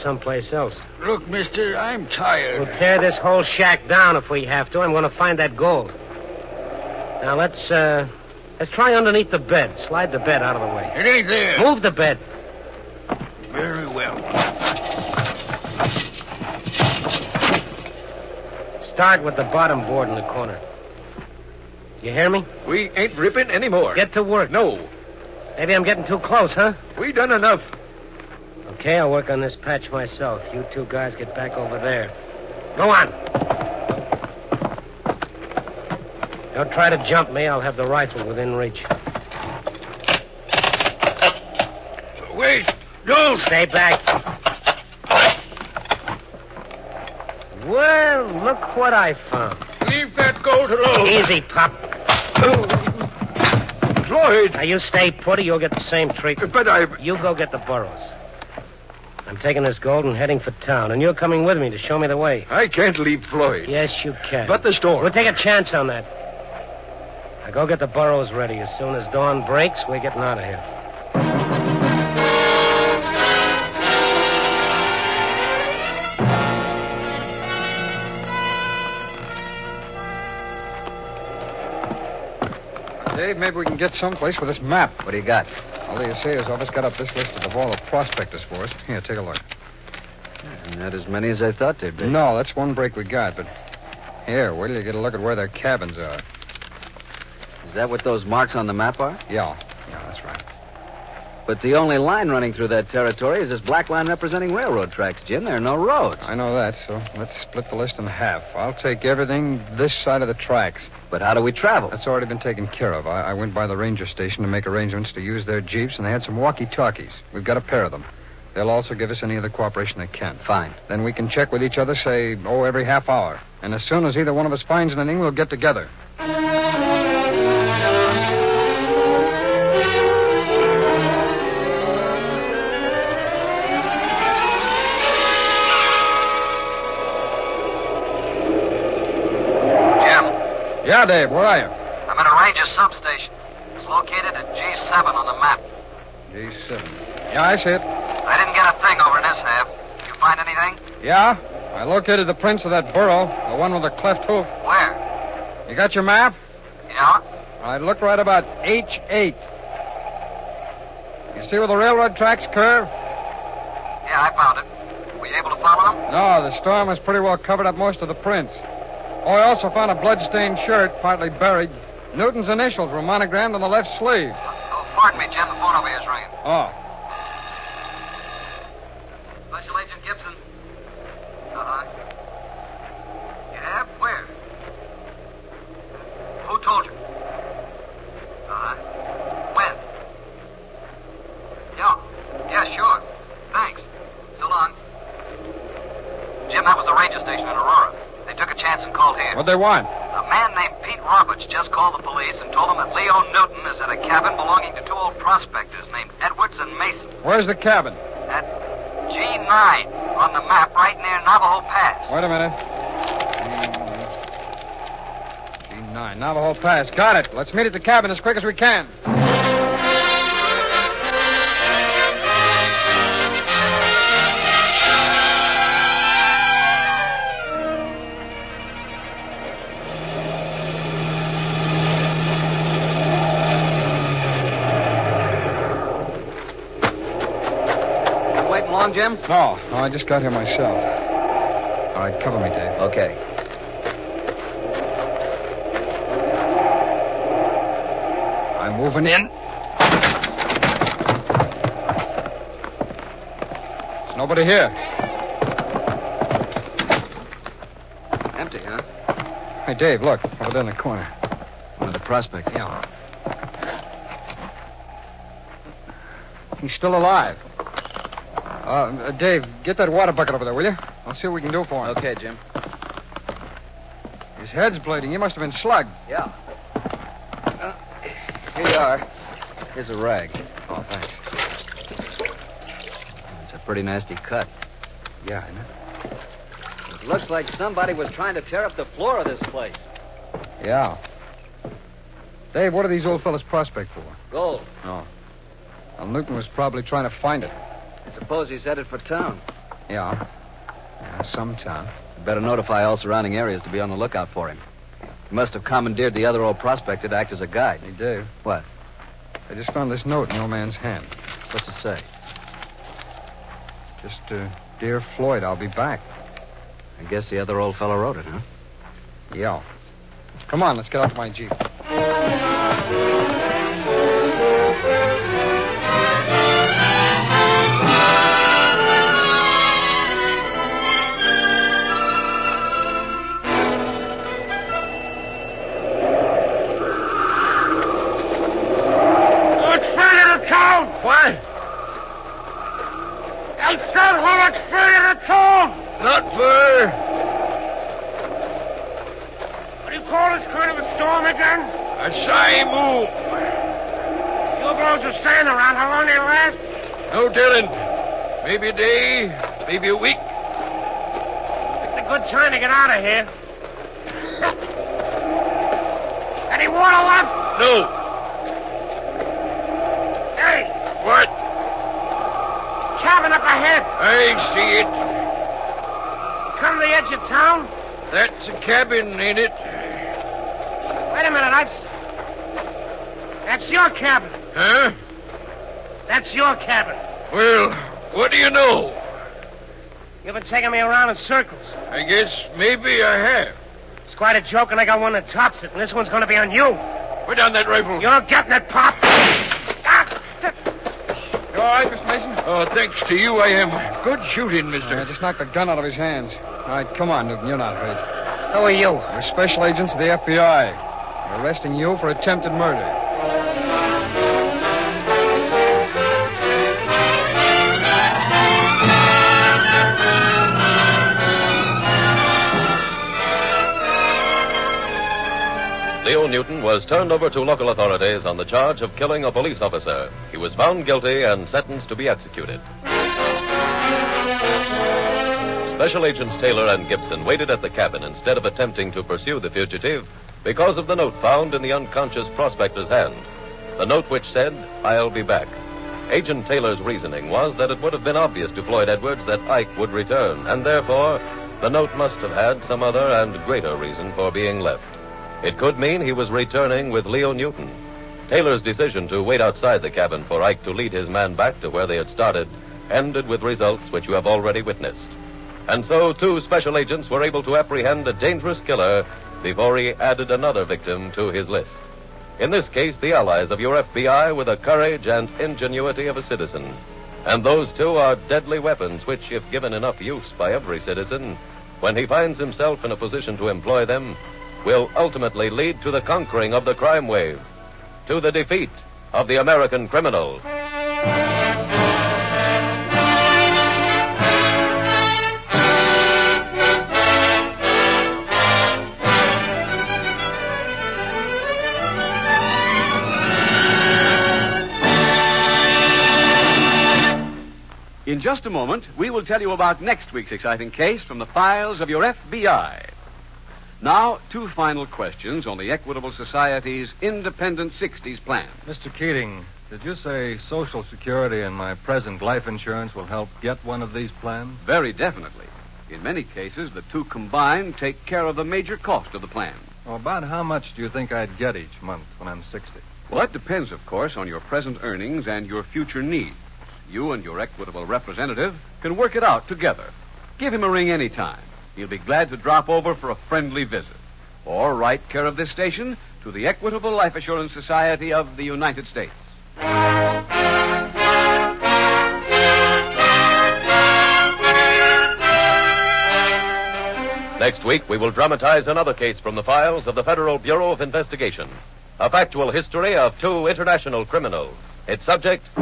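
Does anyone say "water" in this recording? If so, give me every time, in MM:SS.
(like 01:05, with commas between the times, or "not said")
04:29, 06:06.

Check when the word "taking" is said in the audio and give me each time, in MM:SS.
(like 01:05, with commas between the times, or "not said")
00:59, 06:30.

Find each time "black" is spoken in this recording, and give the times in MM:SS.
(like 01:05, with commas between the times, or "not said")
01:43.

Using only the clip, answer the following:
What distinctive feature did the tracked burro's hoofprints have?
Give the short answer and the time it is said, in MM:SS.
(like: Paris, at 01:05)
cleft hoof, at 02:33.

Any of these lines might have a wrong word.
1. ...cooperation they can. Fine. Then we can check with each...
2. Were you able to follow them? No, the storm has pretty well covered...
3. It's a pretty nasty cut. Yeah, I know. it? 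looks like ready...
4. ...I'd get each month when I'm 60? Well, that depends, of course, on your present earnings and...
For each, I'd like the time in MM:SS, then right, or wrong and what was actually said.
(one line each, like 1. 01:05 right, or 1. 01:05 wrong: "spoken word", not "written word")
1. 01:59 right
2. 02:45 right
3. 04:43 wrong: "somebody", not "ready"
4. 08:51 right.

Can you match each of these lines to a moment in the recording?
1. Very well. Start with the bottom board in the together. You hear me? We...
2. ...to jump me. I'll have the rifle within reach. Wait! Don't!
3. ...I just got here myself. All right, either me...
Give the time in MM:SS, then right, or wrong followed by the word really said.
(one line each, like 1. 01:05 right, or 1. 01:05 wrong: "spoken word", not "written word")
1. 00:13 wrong: "corner", not "together"
2. 00:36 right
3. 03:59 wrong: "cover", not "either".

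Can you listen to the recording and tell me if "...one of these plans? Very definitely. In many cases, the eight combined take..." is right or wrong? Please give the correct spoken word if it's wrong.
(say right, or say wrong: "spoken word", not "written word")
wrong: "two", not "eight".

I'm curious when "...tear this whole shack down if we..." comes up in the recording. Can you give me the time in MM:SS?
00:02.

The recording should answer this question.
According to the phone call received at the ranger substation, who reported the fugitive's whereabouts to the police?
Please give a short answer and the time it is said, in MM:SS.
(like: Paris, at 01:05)
Pete Roberts, at 03:20.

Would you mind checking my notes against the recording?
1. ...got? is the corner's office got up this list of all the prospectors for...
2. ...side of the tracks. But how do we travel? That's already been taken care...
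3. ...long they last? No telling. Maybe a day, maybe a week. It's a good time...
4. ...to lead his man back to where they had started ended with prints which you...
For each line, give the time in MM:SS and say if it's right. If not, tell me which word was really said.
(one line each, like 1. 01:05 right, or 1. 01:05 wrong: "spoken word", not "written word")
1. 01:25 wrong: "assayer", not "corner"
2. 01:50 right
3. 05:55 right
4. 07:40 wrong: "results", not "prints".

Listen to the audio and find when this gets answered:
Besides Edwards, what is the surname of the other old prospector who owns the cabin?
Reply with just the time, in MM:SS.
03:26.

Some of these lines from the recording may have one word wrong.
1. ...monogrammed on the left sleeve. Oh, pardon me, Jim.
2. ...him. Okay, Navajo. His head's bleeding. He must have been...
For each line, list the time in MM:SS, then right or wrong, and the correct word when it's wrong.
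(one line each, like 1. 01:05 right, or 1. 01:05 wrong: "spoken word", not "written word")
1. 02:53 right
2. 04:31 wrong: "Jim", not "Navajo".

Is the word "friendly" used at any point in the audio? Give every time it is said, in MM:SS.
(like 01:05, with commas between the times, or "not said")
09:03.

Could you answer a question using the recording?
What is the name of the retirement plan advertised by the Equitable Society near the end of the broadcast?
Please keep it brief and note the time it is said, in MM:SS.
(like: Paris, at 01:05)
Independent 60s plan, at 08:37.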